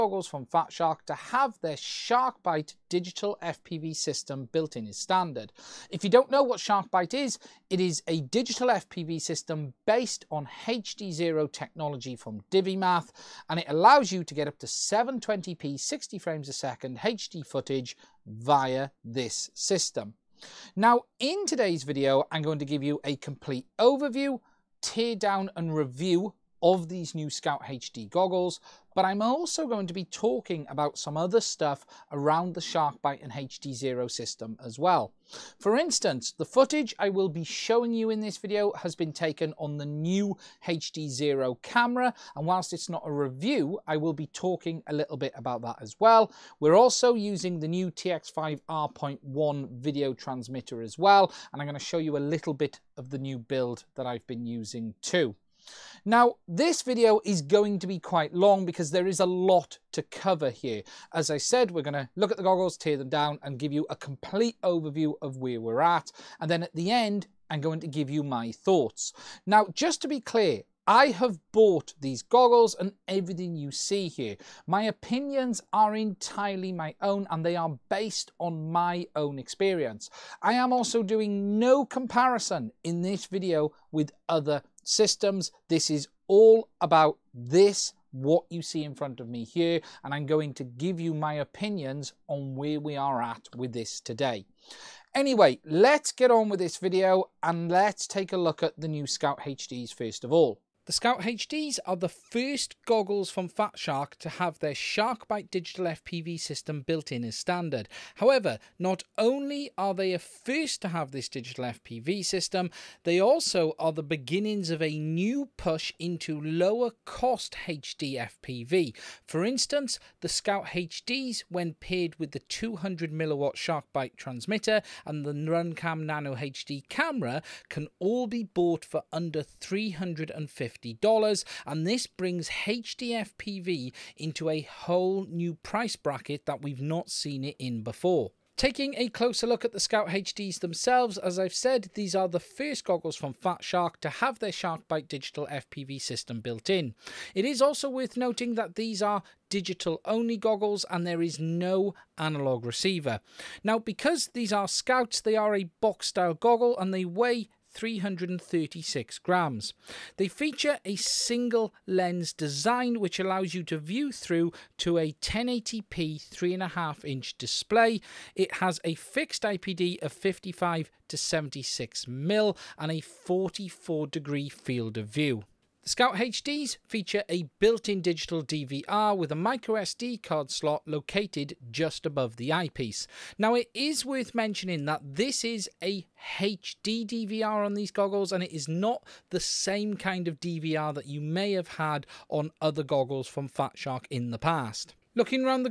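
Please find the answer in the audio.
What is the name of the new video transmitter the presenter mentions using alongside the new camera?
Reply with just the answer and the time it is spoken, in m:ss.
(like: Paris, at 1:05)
TX5 R.1, at 0:47.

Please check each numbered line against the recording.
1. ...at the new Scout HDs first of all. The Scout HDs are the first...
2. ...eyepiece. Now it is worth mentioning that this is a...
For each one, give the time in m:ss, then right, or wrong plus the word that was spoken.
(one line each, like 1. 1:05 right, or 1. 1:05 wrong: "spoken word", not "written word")
1. 1:38 right
2. 3:02 right.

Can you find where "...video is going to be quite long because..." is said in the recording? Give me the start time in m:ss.
0:56.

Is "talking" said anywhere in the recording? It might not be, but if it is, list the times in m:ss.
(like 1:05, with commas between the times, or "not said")
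0:30, 0:44.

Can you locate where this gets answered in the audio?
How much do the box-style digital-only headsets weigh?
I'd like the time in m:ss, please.
2:37.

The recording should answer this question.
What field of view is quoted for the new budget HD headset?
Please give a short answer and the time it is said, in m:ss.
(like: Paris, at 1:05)
44 degrees, at 2:53.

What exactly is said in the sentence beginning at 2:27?
It is also worth noting that these are digital only goggles and there is no analog receiver.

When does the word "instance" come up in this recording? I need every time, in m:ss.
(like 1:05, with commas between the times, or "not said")
0:35, 1:59.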